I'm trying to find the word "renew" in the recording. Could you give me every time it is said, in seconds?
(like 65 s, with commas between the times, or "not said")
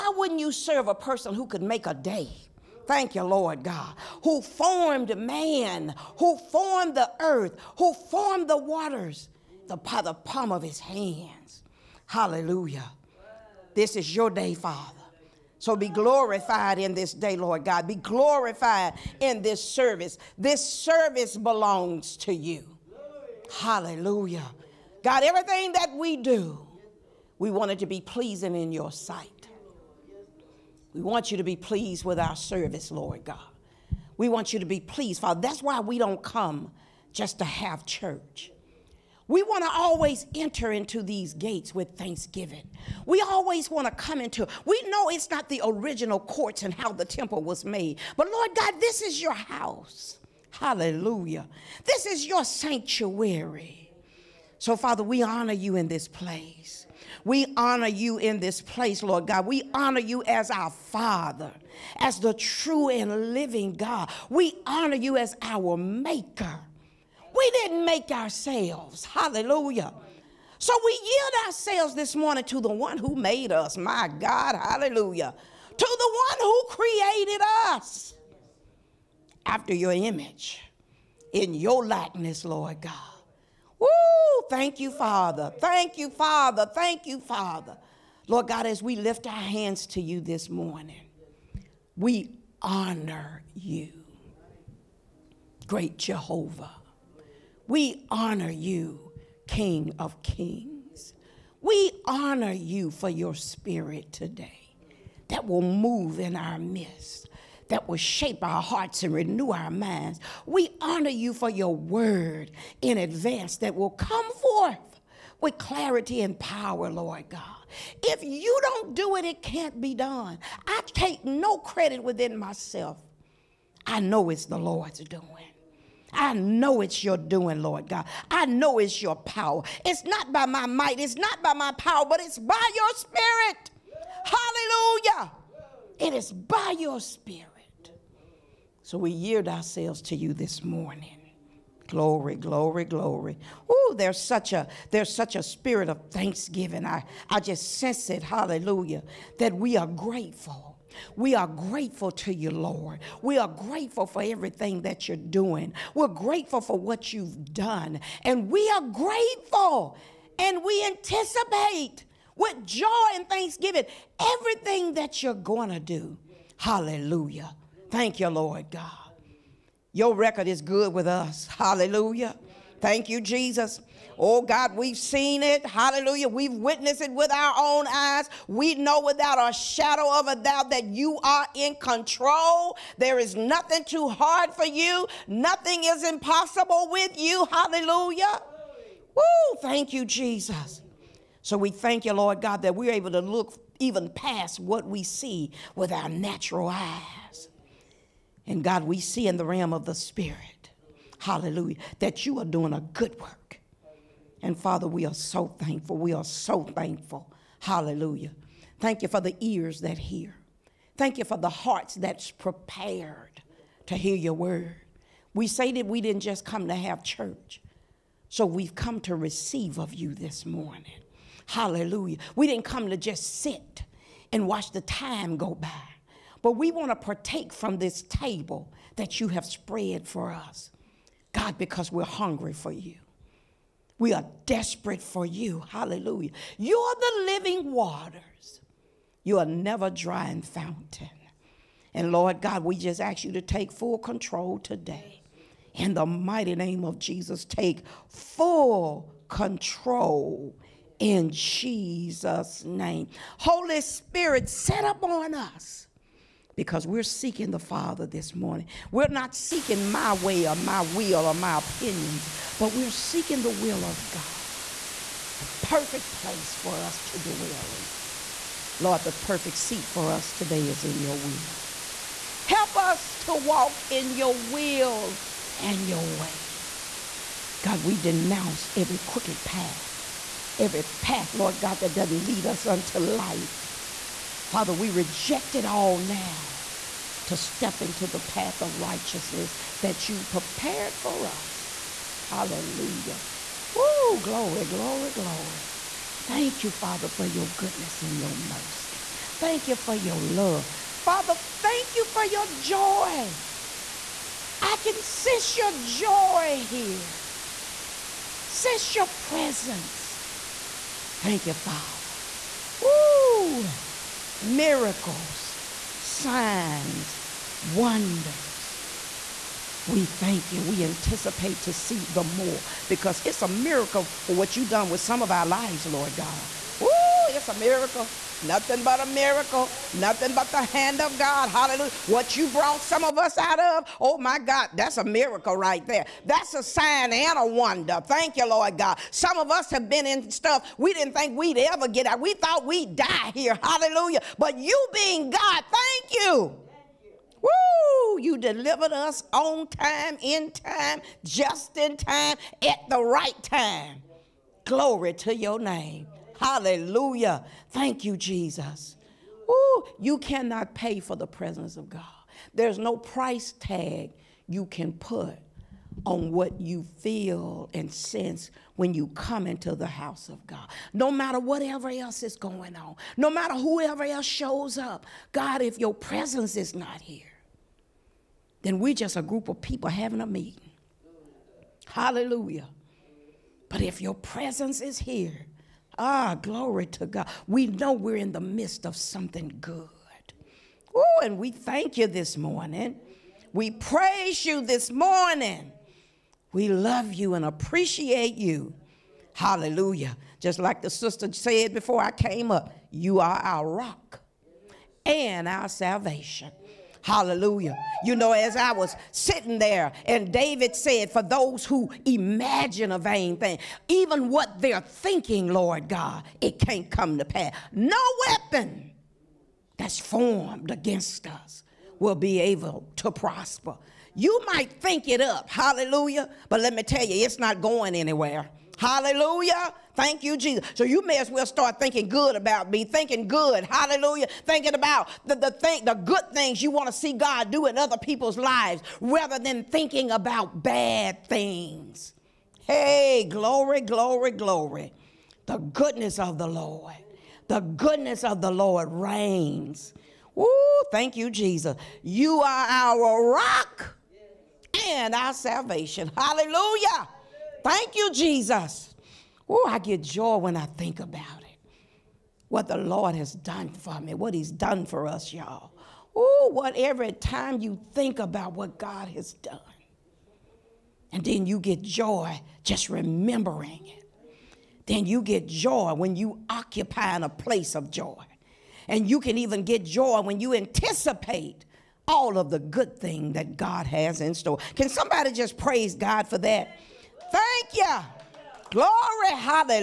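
109 s.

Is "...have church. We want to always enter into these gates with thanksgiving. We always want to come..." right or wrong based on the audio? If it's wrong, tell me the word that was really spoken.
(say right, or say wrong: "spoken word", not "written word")
right.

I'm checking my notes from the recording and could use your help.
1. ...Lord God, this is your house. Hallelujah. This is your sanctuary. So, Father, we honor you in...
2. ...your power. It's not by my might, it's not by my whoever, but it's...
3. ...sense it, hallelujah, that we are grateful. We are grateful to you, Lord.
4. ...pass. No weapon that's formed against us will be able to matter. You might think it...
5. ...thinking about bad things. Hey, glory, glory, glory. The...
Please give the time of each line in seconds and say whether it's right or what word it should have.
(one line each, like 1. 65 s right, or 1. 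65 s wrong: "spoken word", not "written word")
1. 48 s right
2. 129 s wrong: "power", not "whoever"
3. 147 s right
4. 417 s wrong: "prosper", not "matter"
5. 439 s right.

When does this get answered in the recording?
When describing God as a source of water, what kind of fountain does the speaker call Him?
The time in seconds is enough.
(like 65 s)
239 s.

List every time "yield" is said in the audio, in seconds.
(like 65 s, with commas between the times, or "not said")
71 s, 139 s.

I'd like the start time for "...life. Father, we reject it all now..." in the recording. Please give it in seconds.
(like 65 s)
282 s.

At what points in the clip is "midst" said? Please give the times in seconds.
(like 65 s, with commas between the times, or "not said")
106 s, 388 s.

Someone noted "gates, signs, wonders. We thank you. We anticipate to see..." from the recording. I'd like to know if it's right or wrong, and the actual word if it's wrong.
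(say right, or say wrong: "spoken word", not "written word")
wrong: "miracles", not "gates".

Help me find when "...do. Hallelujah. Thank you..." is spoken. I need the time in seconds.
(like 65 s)
165 s.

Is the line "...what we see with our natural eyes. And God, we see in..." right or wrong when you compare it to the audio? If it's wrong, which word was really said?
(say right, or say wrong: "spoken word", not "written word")
right.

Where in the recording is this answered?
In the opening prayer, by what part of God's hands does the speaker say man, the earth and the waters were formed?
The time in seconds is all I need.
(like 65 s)
10 s.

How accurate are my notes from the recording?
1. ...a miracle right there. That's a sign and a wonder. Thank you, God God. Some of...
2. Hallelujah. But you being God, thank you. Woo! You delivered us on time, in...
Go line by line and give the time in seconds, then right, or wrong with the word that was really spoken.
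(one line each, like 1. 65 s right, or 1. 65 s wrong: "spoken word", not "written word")
1. 334 s wrong: "Lord", not "God"
2. 343 s right.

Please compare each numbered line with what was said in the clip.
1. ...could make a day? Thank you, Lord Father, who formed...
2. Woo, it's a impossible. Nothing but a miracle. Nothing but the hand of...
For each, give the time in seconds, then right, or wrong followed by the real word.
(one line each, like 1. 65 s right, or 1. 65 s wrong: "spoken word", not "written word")
1. 1 s wrong: "God", not "Father"
2. 326 s wrong: "miracle", not "impossible".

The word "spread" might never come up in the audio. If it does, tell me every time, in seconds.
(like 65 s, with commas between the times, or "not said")
229 s.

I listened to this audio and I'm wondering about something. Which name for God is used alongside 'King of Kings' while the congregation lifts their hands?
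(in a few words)
Jehovah.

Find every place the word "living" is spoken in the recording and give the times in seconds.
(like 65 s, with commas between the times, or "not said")
63 s, 237 s.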